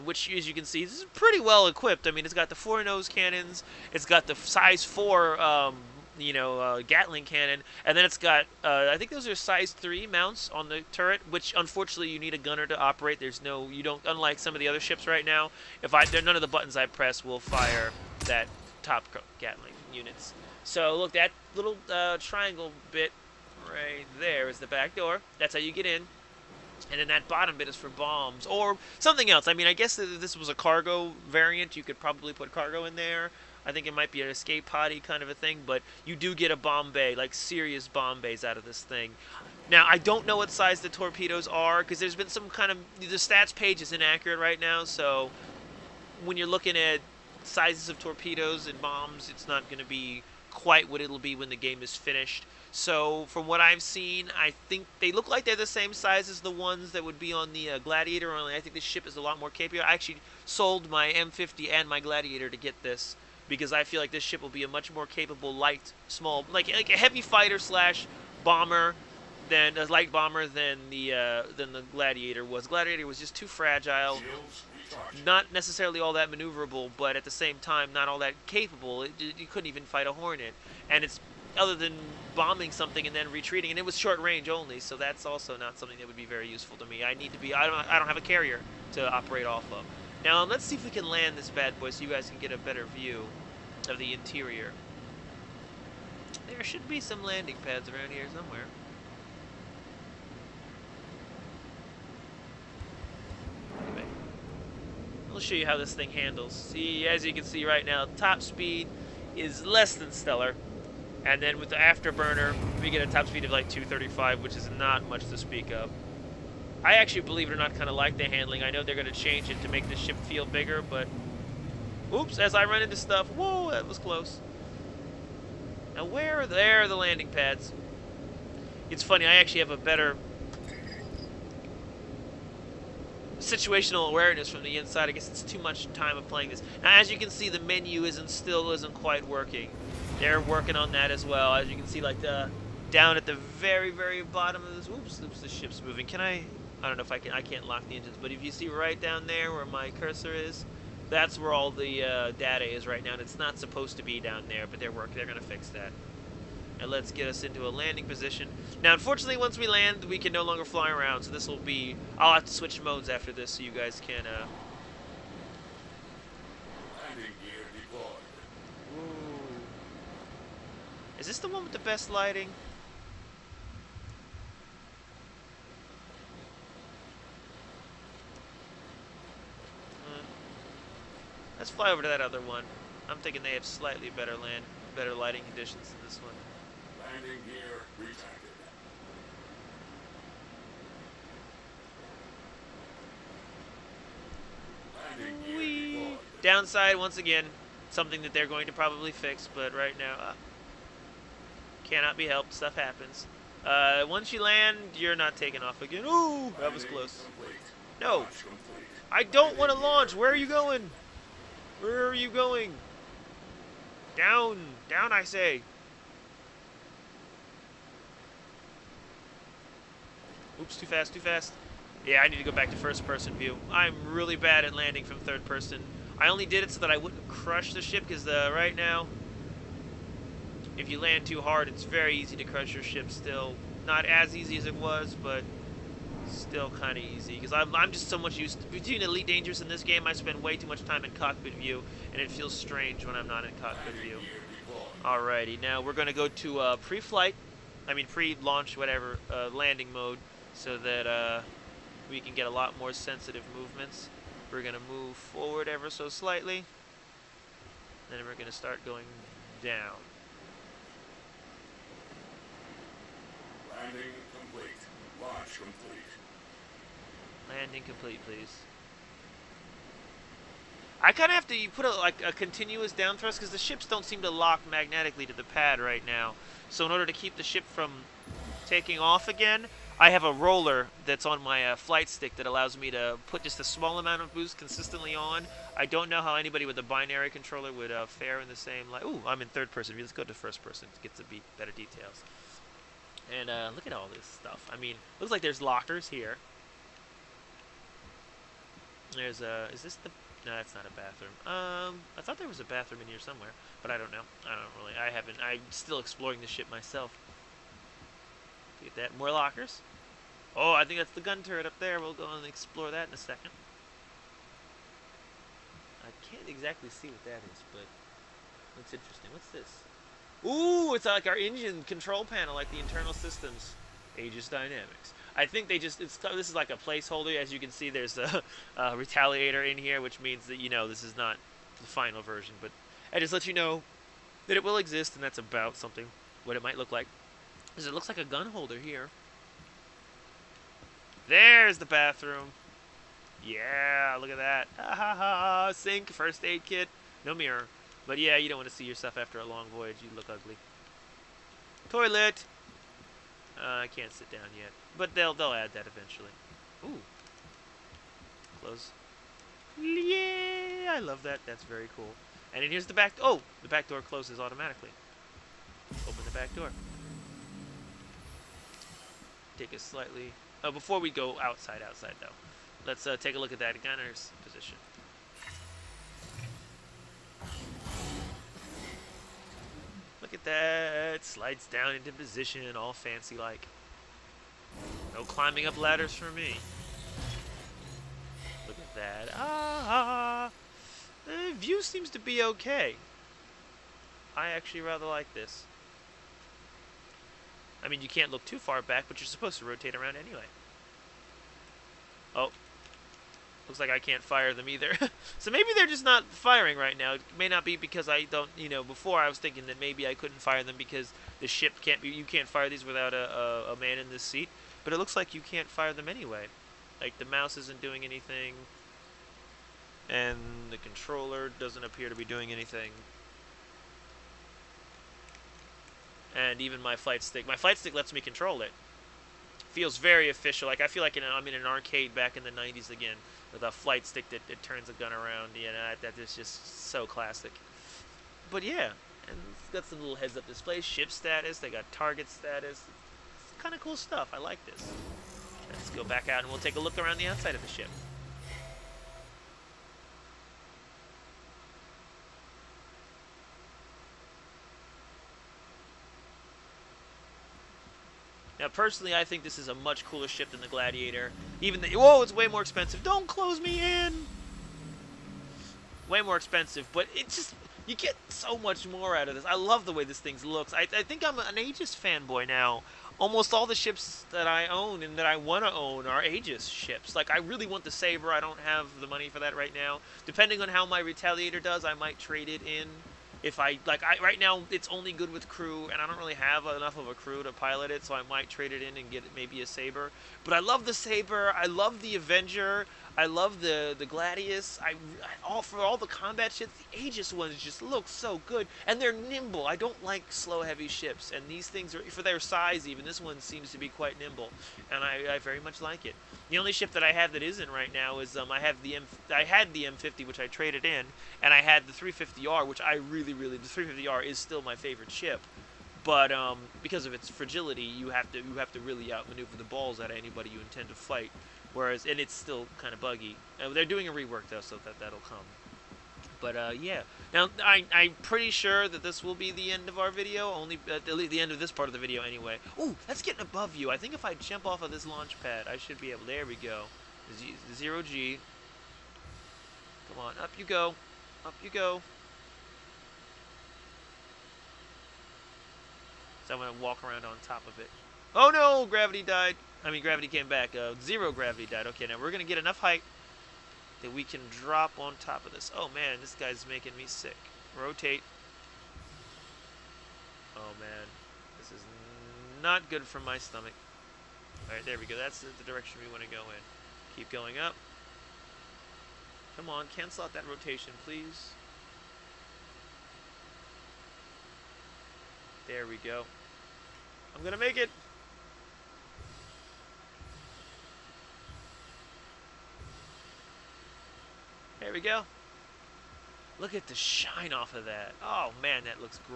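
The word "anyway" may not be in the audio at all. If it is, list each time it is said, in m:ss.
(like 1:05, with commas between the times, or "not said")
6:40, 6:56, 8:52.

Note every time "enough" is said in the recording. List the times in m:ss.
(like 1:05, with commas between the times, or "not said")
8:06, 9:12.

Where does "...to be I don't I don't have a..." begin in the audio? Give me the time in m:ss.
1:27.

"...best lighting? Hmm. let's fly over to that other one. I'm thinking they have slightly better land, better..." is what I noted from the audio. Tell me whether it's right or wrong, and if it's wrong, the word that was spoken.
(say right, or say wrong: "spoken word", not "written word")
right.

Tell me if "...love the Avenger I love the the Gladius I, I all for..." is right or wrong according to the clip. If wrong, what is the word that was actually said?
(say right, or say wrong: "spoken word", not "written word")
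right.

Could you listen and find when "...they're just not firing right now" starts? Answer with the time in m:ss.
6:45.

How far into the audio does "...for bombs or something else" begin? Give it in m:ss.
0:27.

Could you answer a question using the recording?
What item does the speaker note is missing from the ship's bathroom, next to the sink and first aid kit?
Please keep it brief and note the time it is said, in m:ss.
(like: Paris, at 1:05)
Mirror, at 5:47.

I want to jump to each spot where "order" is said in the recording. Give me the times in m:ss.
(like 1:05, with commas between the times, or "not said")
4:36.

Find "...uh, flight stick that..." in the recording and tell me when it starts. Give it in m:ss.
4:41.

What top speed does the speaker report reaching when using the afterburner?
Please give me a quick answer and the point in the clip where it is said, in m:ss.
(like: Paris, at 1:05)
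235, at 1:53.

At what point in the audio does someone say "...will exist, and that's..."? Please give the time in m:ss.
5:34.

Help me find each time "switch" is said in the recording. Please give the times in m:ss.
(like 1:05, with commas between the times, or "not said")
2:42.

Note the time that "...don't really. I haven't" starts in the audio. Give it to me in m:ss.
5:04.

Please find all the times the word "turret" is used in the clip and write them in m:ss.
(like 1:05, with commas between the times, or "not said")
0:10, 5:11.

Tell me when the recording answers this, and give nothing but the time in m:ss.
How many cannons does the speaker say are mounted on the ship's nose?
0:02.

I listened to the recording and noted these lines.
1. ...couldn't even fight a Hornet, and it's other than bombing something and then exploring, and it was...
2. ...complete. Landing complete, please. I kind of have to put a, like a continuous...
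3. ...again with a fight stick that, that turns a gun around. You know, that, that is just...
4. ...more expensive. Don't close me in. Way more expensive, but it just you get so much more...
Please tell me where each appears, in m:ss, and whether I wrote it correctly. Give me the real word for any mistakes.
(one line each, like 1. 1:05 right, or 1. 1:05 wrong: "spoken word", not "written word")
1. 1:19 wrong: "retreating", not "exploring"
2. 4:25 right
3. 7:12 wrong: "flight", not "fight"
4. 7:42 right.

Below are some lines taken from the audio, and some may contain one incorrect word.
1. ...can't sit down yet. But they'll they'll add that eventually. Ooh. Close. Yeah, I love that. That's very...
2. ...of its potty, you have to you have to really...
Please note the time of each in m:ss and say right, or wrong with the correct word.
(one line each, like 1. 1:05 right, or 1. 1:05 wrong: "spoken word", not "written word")
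1. 5:53 right
2. 8:37 wrong: "fragility", not "potty".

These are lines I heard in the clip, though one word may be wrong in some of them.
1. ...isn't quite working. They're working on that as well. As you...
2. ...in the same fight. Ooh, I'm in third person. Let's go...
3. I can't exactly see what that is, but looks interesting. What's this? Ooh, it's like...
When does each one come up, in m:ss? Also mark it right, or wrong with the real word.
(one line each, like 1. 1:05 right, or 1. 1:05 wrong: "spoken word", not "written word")
1. 2:18 right
2. 4:48 wrong: "light", not "fight"
3. 5:16 right.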